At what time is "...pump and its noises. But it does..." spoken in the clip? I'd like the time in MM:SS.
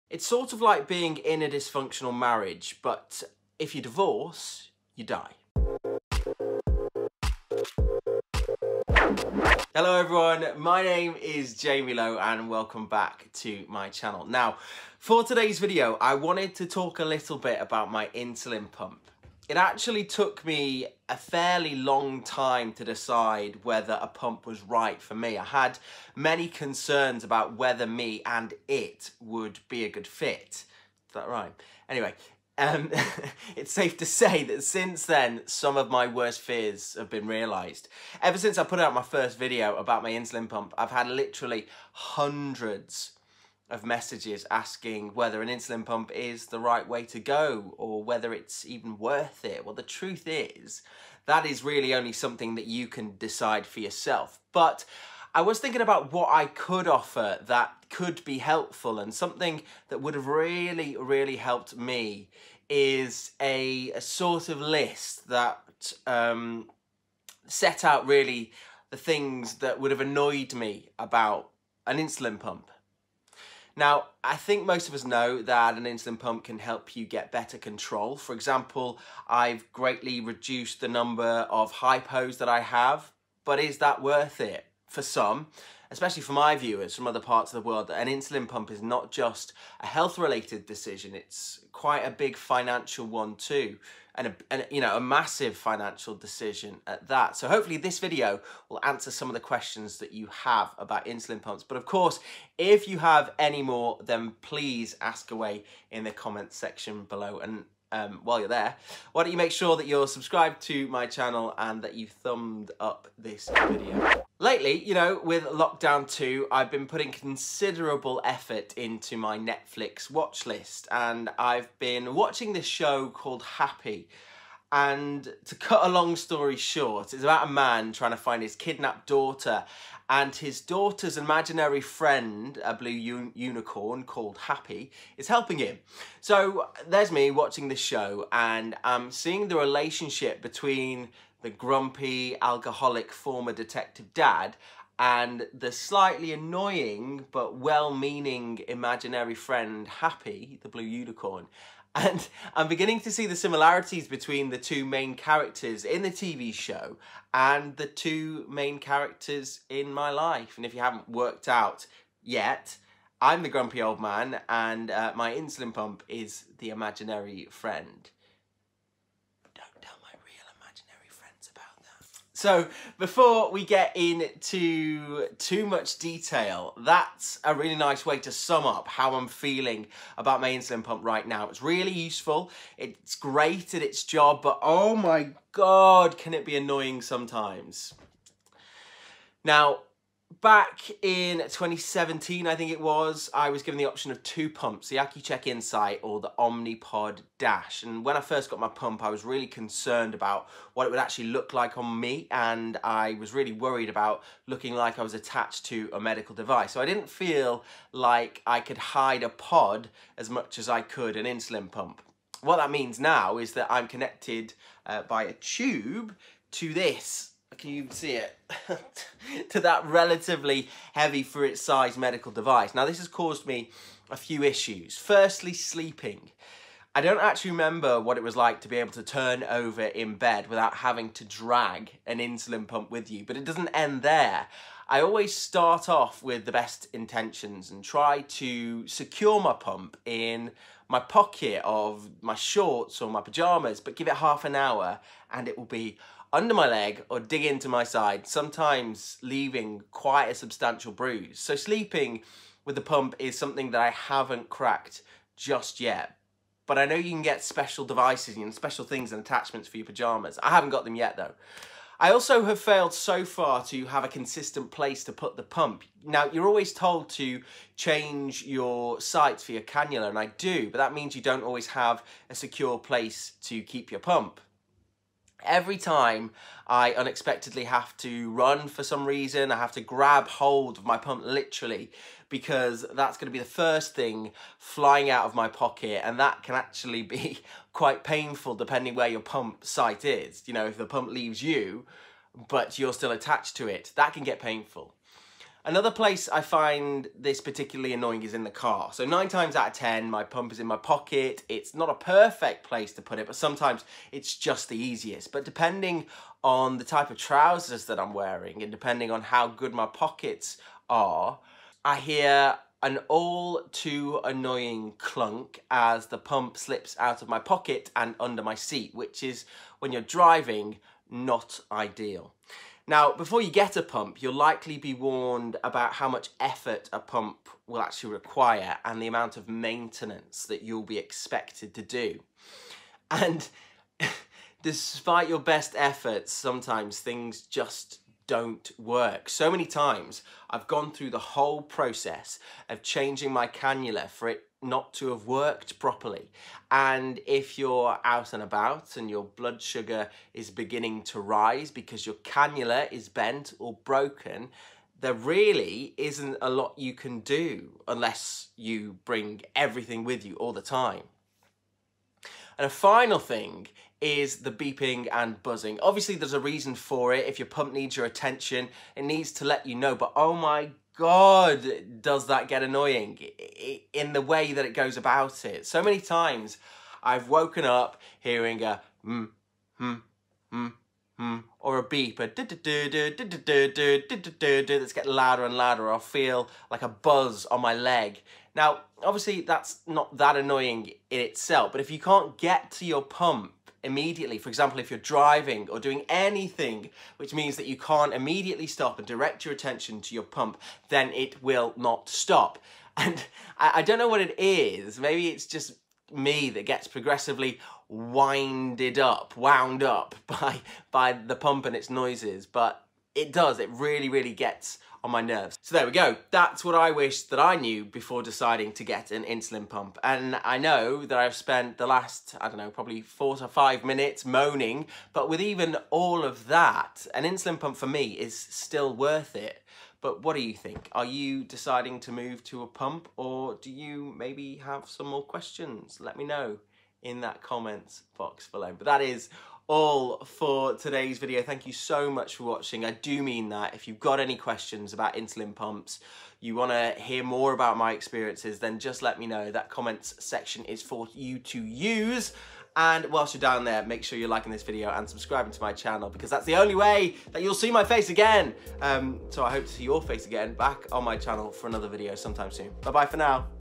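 06:51.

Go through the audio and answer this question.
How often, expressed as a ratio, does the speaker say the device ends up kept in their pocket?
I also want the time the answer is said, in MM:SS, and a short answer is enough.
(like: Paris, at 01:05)
9 times out of 10, at 04:59.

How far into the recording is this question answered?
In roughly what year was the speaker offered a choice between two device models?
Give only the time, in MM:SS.
03:11.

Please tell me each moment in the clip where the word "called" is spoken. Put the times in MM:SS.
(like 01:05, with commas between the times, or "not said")
02:03, 02:14.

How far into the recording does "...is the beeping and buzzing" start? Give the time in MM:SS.
06:03.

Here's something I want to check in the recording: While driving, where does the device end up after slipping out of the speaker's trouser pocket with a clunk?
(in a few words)
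Under my seat.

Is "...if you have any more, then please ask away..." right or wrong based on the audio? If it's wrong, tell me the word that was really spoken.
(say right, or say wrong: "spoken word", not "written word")
right.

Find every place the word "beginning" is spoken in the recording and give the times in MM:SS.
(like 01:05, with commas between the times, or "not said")
02:32, 05:50.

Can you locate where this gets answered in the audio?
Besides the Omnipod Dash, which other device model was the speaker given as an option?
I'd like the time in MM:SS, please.
03:14.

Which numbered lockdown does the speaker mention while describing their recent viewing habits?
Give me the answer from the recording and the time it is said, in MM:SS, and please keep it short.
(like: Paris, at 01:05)
Lockdown 2, at 01:55.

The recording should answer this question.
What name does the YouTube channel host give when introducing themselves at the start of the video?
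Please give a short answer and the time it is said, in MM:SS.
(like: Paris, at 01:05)
Jamie Lowe, at 00:11.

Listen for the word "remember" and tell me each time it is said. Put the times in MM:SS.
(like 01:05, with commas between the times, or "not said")
03:47.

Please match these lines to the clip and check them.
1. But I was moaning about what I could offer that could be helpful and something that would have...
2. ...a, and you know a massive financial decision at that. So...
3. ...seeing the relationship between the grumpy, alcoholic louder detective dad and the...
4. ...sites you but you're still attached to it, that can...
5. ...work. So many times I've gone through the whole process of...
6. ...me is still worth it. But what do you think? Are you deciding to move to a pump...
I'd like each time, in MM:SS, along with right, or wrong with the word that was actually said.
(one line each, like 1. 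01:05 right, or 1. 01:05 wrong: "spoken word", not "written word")
1. 00:54 wrong: "thinking", not "moaning"
2. 01:34 right
3. 02:19 wrong: "former", not "louder"
4. 04:51 wrong: "leaves", not "sites"
5. 05:38 right
6. 07:07 right.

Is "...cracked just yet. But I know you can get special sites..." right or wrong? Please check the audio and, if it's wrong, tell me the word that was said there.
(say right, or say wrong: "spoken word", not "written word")
wrong: "devices", not "sites".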